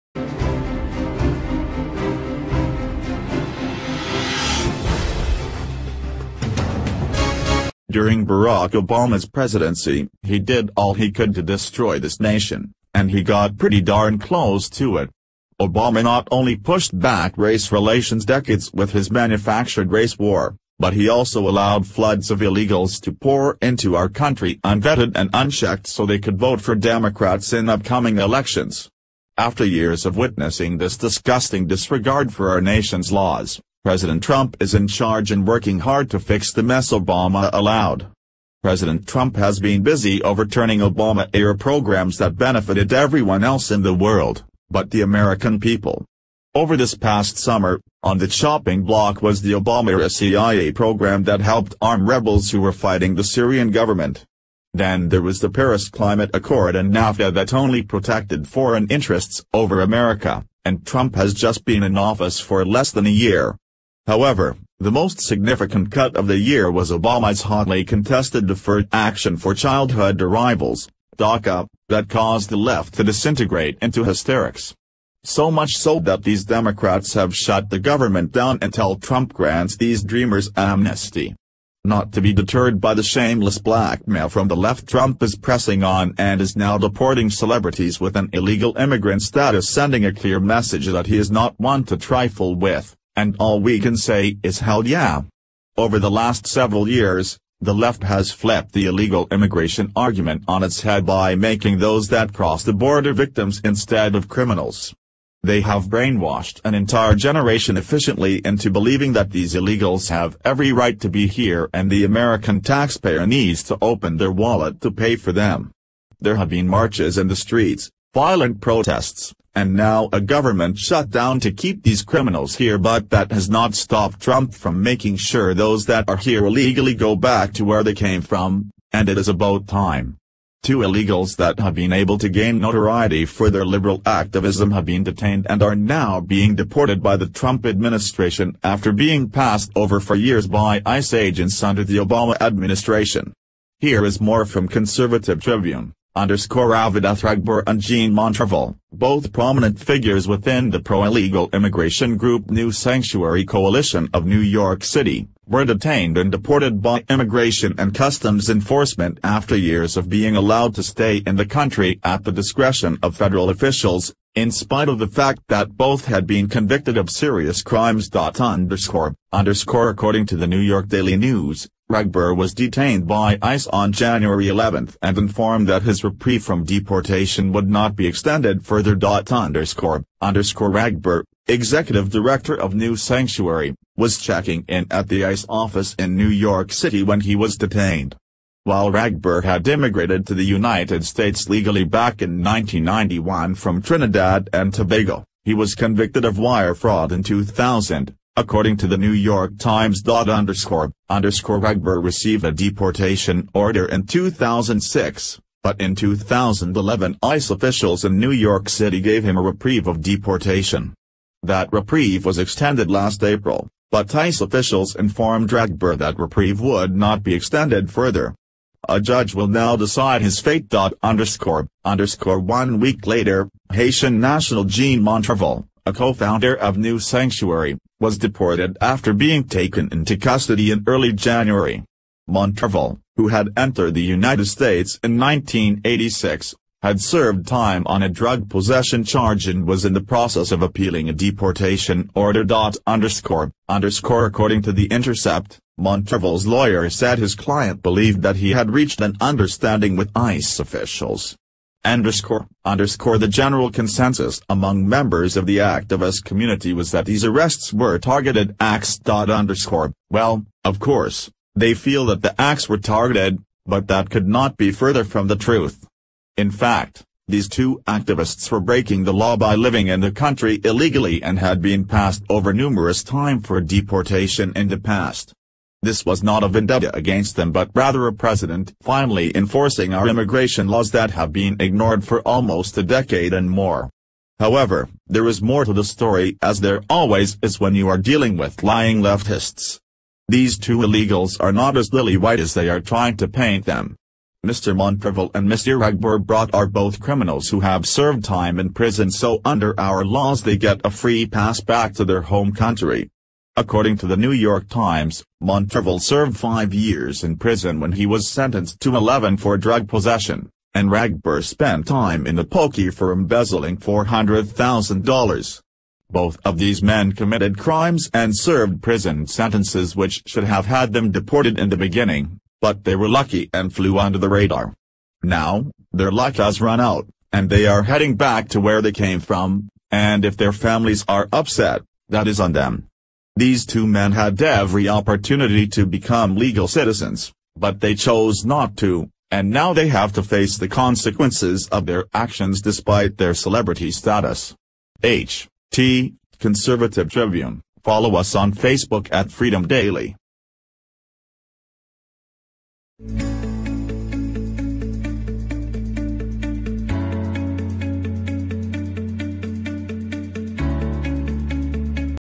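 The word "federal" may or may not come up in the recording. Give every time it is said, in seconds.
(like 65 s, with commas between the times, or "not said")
163 s.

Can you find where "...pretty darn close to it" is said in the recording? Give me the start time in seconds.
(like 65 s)
13 s.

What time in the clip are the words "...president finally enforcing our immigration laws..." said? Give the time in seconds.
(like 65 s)
278 s.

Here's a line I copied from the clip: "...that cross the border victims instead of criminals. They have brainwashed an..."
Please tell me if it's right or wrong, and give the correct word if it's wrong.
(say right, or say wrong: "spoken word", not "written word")
right.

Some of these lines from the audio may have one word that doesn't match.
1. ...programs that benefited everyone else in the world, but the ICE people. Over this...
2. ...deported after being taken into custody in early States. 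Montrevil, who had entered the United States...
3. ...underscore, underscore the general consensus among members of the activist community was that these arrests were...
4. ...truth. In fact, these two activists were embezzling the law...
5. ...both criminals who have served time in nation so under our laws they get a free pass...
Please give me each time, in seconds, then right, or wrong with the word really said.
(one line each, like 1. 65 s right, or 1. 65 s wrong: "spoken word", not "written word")
1. 41 s wrong: "American", not "ICE"
2. 228 s wrong: "January", not "States"
3. 251 s right
4. 265 s wrong: "breaking", not "embezzling"
5. 296 s wrong: "prison", not "nation".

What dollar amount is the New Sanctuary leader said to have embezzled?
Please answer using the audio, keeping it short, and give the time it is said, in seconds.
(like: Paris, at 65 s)
$400,000, at 313 s.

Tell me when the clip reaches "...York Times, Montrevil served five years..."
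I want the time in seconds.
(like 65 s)
304 s.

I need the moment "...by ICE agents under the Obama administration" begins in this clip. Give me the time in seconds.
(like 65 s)
140 s.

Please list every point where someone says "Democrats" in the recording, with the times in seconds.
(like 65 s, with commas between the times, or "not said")
26 s, 76 s.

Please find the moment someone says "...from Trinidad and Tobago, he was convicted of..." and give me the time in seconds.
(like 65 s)
193 s.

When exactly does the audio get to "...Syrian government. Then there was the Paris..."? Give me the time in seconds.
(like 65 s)
53 s.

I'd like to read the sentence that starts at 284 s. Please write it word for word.
However, there is more to the story as there always is when you are dealing with lying leftists.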